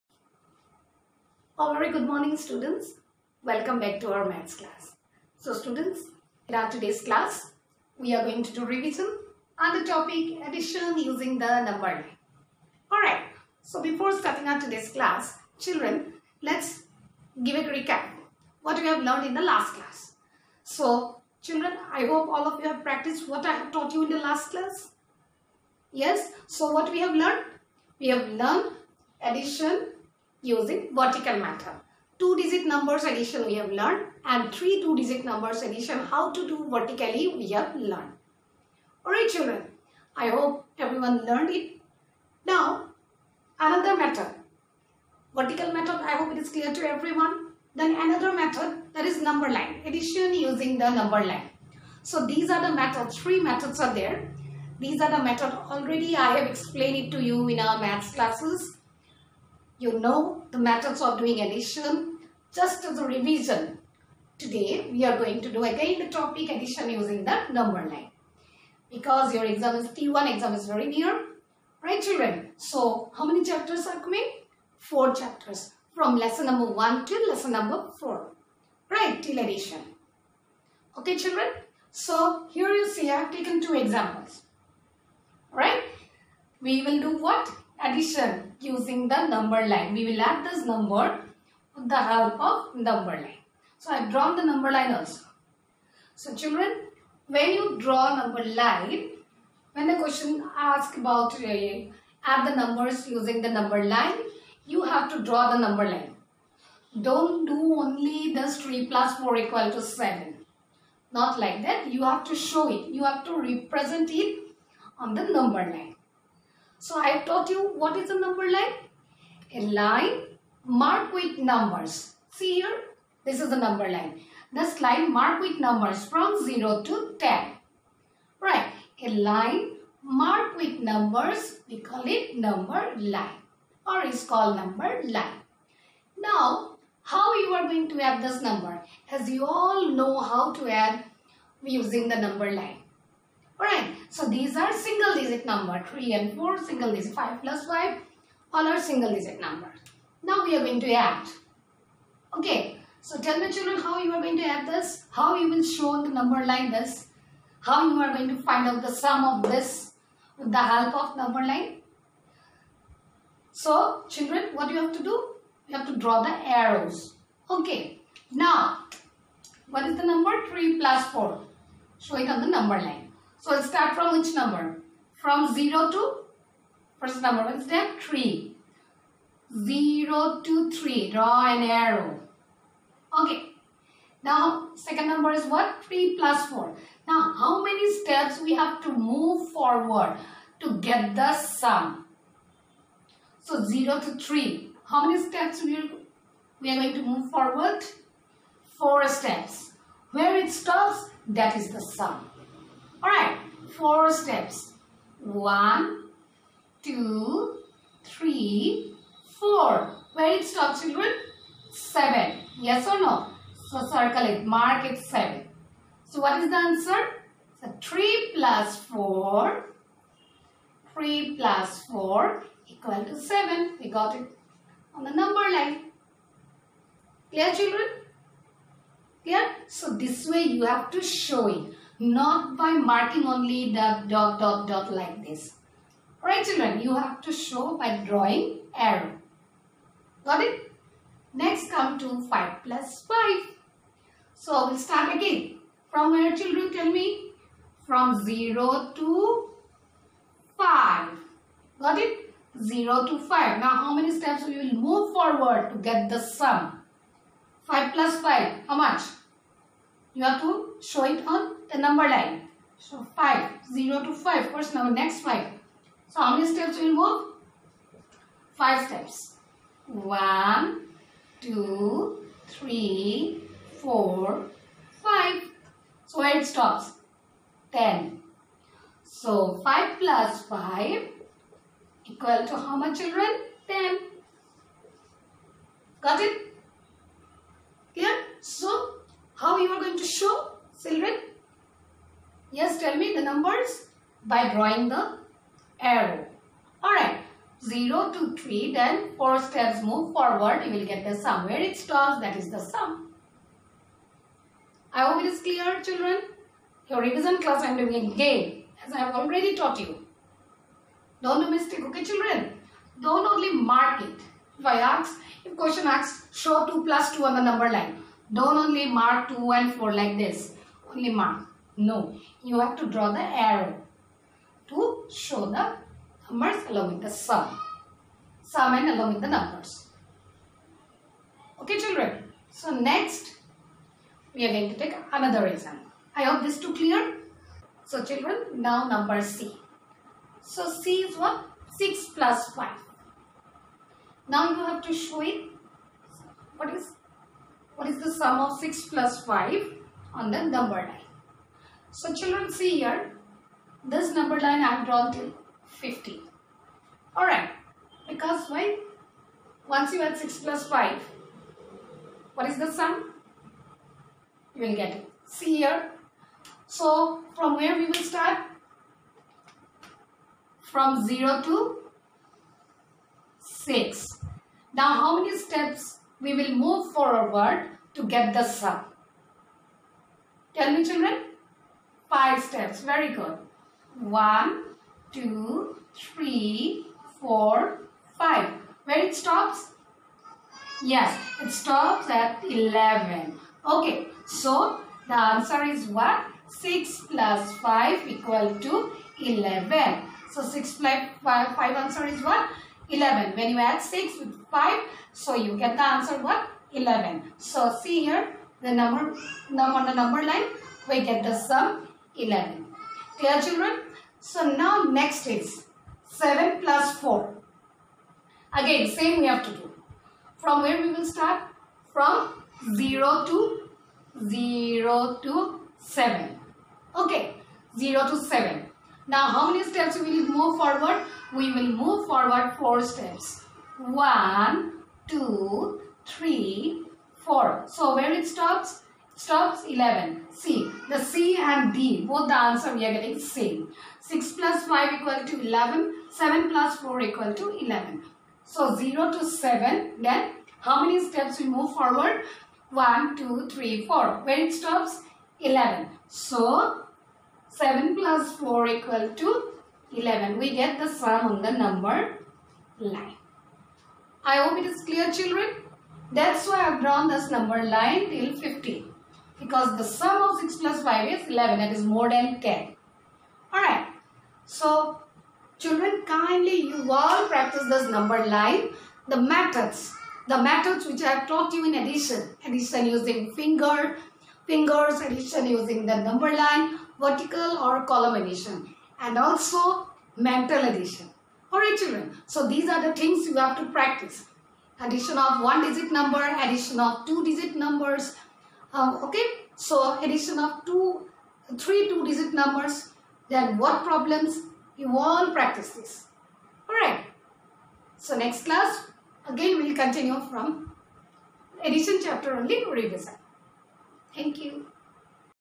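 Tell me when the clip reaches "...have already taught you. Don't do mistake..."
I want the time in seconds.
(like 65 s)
308 s.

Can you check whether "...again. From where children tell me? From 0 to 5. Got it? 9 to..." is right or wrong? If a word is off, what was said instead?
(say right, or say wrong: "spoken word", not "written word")
wrong: "0", not "9".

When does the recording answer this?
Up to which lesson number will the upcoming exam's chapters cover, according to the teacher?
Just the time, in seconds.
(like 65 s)
77 s.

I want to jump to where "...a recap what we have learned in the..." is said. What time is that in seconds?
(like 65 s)
17 s.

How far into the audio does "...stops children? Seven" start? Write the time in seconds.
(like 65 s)
210 s.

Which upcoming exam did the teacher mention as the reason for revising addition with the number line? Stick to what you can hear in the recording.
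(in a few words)
T1 exam.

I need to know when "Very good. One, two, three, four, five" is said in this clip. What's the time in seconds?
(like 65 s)
382 s.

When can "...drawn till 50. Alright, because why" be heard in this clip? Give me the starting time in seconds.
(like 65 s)
354 s.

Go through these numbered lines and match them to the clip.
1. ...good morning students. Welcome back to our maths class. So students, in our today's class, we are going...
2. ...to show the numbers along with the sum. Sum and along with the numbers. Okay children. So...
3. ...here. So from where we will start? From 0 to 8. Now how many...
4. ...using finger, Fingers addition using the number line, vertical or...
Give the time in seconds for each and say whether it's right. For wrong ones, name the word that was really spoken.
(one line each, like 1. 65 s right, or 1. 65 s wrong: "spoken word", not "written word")
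1. 1 s right
2. 324 s right
3. 365 s wrong: "6", not "8"
4. 482 s right.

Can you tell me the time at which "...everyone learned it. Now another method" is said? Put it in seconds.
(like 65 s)
40 s.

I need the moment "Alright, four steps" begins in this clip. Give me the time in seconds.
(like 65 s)
203 s.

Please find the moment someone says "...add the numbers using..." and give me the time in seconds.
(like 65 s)
102 s.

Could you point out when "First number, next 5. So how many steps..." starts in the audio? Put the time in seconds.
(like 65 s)
264 s.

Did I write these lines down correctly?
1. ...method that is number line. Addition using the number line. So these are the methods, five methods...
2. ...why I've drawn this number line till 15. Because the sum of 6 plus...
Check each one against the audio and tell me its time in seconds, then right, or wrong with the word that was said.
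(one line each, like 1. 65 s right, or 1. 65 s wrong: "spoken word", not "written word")
1. 48 s wrong: "three", not "five"
2. 466 s right.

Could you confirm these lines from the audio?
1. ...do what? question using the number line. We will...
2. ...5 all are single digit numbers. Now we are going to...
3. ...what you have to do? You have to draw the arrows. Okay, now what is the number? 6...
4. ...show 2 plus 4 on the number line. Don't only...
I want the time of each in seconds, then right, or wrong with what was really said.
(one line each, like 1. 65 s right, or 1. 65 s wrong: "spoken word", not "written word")
1. 87 s wrong: "addition", not "question"
2. 147 s right
3. 164 s wrong: "3", not "6"
4. 316 s wrong: "2", not "4".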